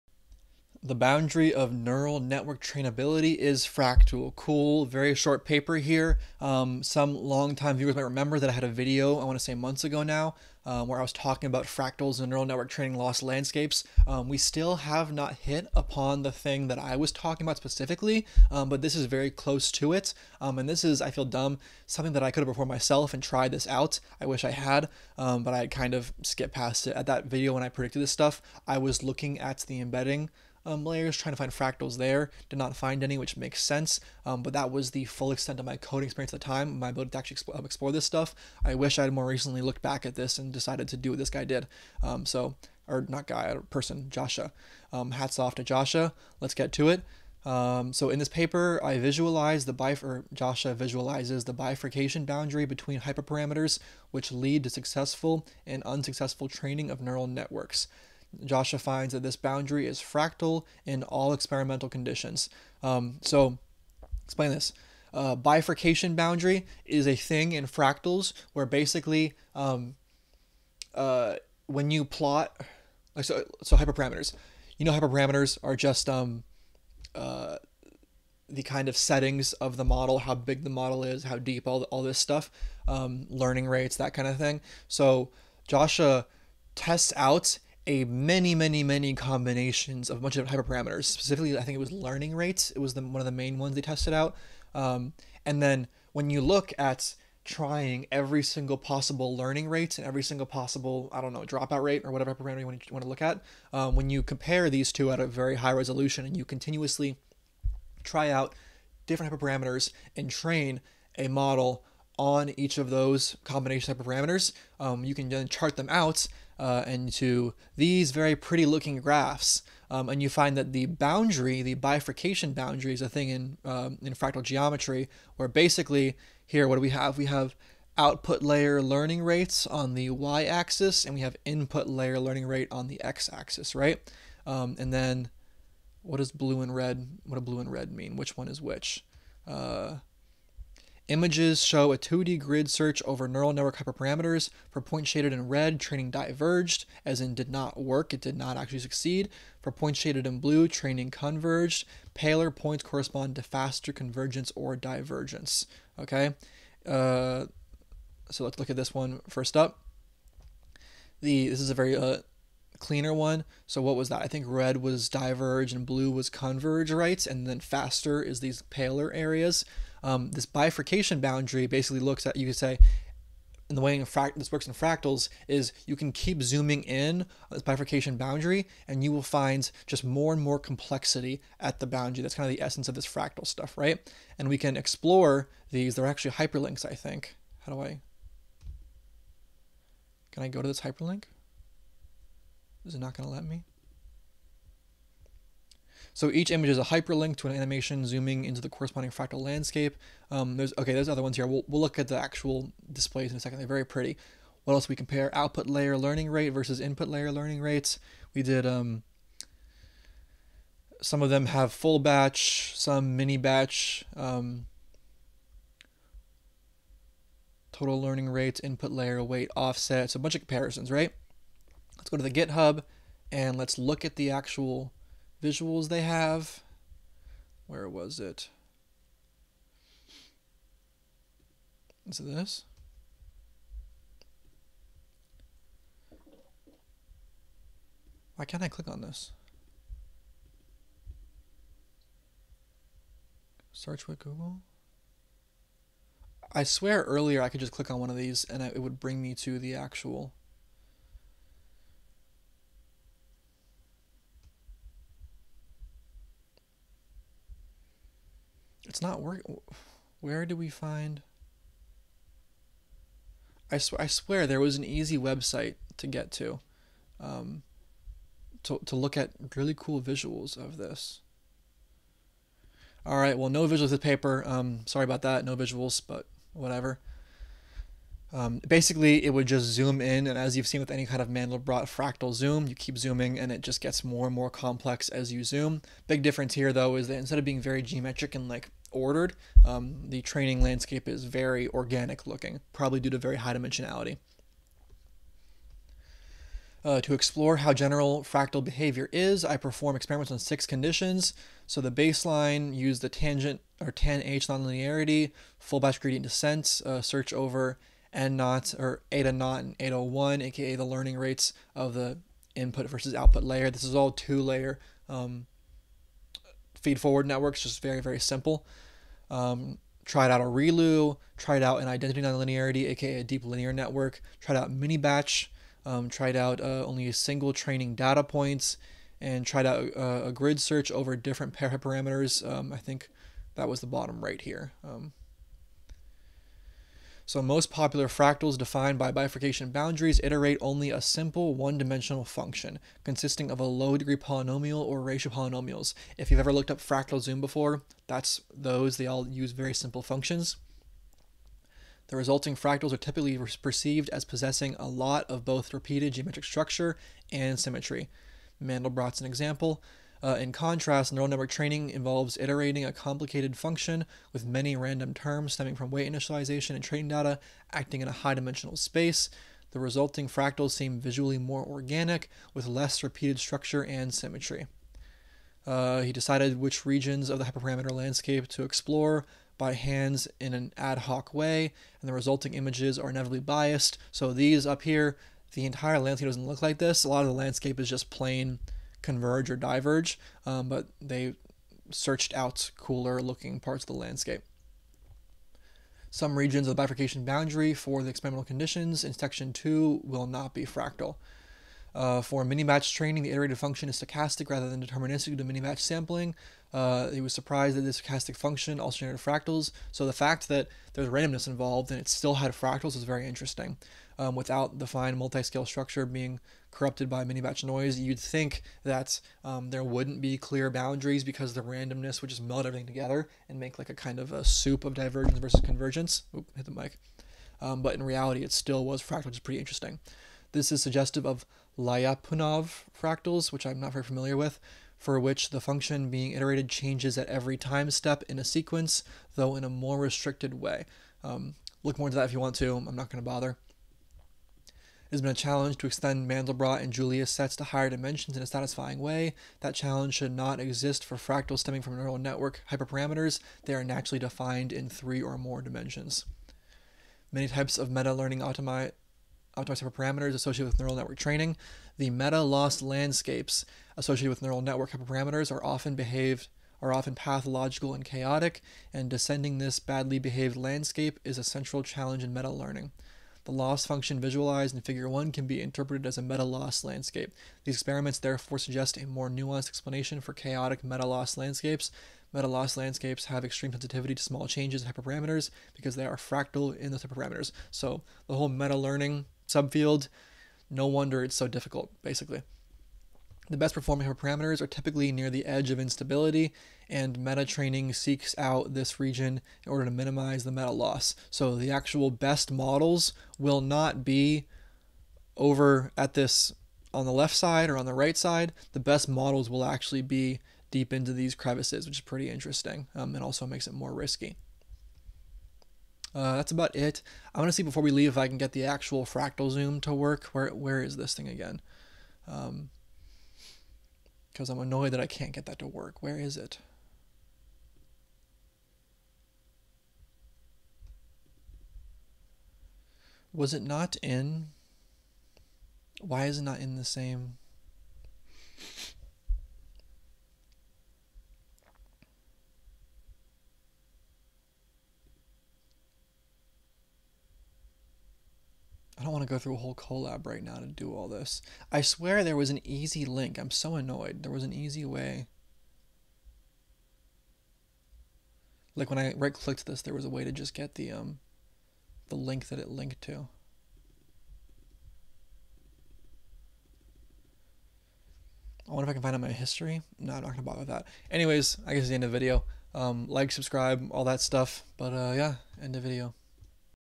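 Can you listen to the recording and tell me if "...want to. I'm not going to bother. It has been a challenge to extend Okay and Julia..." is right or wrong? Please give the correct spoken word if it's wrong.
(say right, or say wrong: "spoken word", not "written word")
wrong: "Mandelbrot", not "Okay".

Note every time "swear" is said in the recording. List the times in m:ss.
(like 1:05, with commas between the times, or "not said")
4:06, 4:24, 9:11.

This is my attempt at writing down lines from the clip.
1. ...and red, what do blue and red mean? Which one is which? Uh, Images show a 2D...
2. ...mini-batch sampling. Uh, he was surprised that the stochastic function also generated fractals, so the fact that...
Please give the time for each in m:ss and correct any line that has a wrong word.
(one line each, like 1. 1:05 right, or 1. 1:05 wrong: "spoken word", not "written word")
1. 2:16 right
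2. 6:45 right.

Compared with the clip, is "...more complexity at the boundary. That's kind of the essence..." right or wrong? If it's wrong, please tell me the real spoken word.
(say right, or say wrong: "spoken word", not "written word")
right.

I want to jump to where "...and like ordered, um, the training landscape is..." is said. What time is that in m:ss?
4:48.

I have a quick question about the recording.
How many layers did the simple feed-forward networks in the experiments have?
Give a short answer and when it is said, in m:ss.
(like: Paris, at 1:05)
2, at 5:14.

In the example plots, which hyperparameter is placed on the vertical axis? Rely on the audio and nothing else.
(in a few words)
Output layer learning rate.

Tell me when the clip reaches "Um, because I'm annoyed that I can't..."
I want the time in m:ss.
8:42.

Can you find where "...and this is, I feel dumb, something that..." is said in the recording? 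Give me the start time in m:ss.
0:20.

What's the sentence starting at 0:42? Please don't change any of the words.
Um, so, or not guy, or person, Joshua.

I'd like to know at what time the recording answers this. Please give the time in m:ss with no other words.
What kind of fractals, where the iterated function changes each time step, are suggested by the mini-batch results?
7:11.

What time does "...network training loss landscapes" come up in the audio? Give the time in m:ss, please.
0:12.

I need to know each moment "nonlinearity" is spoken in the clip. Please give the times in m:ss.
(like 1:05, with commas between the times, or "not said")
5:04, 5:22.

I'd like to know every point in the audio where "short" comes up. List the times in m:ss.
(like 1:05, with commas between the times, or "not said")
0:05.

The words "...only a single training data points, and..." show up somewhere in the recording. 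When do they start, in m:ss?
5:26.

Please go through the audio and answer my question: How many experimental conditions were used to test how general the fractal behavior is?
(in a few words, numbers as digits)
6.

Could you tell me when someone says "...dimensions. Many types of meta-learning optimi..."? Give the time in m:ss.
7:35.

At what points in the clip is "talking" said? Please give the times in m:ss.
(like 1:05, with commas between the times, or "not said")
0:11, 0:17.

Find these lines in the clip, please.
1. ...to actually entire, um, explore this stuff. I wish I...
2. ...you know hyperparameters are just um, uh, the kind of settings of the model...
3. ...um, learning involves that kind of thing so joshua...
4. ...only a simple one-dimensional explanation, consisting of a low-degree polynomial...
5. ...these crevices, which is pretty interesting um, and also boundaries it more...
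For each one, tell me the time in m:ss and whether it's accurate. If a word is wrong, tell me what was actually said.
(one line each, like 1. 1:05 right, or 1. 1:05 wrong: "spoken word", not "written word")
1. 0:37 wrong: "explore", not "entire"
2. 1:14 right
3. 1:22 wrong: "rates", not "involves"
4. 5:40 wrong: "function", not "explanation"
5. 8:31 wrong: "makes", not "boundaries".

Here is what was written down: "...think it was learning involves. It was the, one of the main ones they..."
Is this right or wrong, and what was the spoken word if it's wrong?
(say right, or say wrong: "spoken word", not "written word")
wrong: "rates", not "involves".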